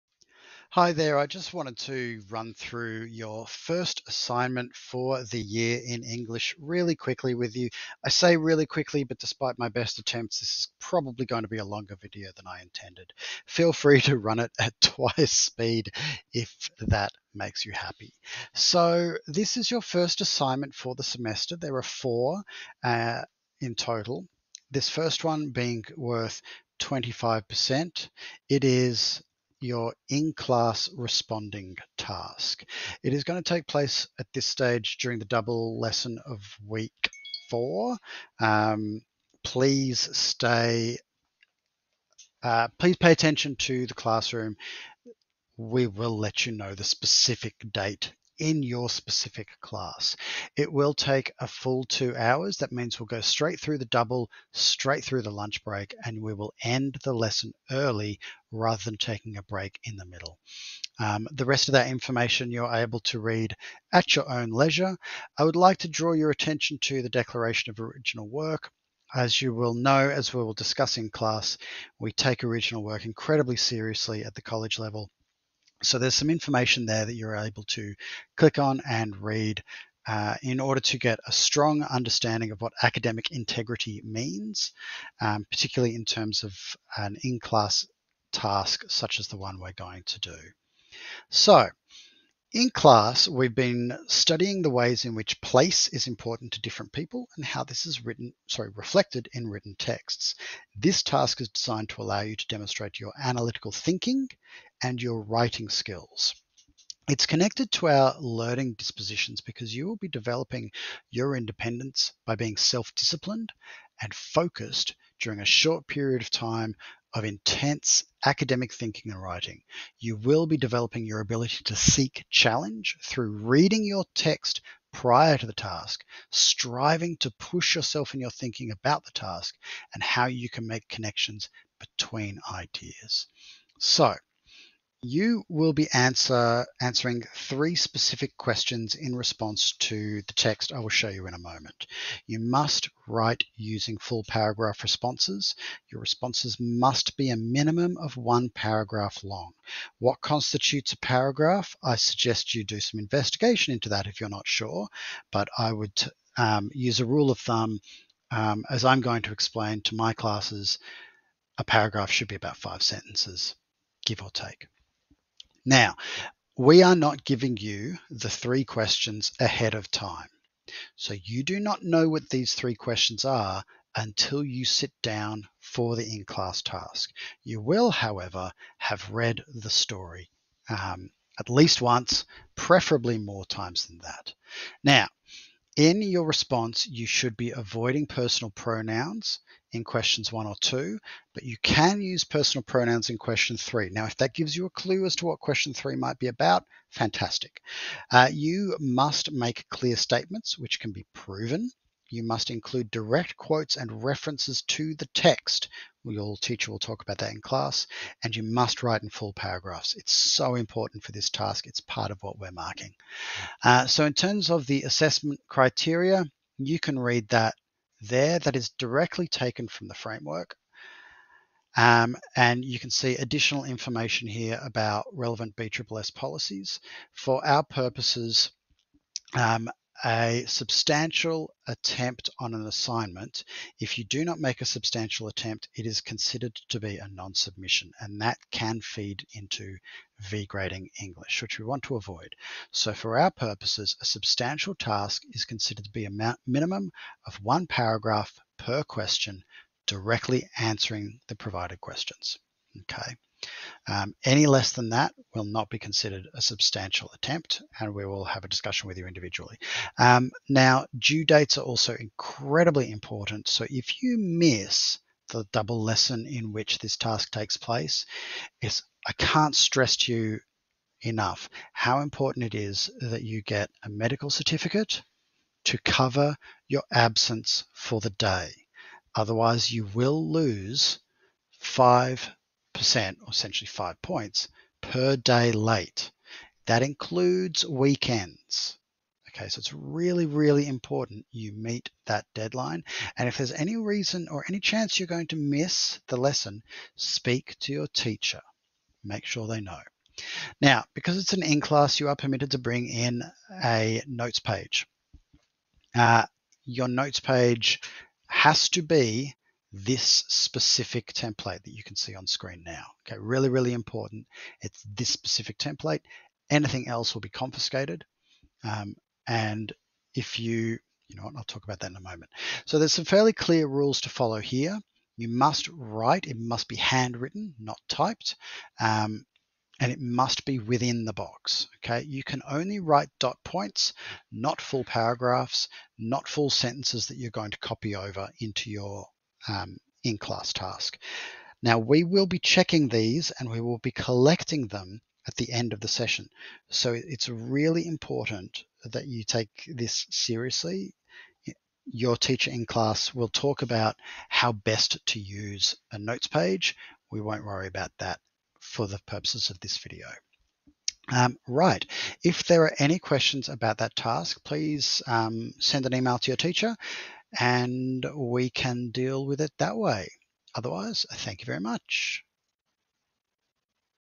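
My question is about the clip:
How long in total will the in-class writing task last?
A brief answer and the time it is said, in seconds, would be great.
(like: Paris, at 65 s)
two hours, at 51 s.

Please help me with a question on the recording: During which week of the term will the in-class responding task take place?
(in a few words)
week four.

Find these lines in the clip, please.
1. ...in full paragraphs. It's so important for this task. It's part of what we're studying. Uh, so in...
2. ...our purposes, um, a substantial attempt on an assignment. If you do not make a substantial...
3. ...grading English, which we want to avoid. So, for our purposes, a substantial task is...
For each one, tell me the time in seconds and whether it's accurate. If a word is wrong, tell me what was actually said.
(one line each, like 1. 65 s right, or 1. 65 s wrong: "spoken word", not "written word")
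1. 209 s wrong: "marking", not "studying"
2. 227 s right
3. 240 s right.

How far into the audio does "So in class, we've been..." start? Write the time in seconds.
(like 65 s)
91 s.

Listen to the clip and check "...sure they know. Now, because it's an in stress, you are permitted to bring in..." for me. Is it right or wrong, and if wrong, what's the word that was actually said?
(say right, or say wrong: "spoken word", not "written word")
wrong: "class", not "stress".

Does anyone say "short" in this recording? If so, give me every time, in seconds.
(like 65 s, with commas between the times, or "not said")
115 s.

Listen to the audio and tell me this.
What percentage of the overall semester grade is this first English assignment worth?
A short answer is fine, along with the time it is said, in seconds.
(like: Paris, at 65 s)
25%, at 26 s.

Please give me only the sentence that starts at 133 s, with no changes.
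So, you will be answer, answering three specific questions in response to the text I will show you in a moment.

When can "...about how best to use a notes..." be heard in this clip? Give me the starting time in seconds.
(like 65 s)
353 s.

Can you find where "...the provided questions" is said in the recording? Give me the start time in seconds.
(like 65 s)
251 s.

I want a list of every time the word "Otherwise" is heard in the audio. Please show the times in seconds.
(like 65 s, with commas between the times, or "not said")
279 s, 370 s.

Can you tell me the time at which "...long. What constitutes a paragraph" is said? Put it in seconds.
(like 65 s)
149 s.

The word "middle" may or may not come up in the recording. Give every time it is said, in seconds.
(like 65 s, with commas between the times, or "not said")
60 s.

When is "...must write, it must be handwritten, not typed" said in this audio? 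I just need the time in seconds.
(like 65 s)
325 s.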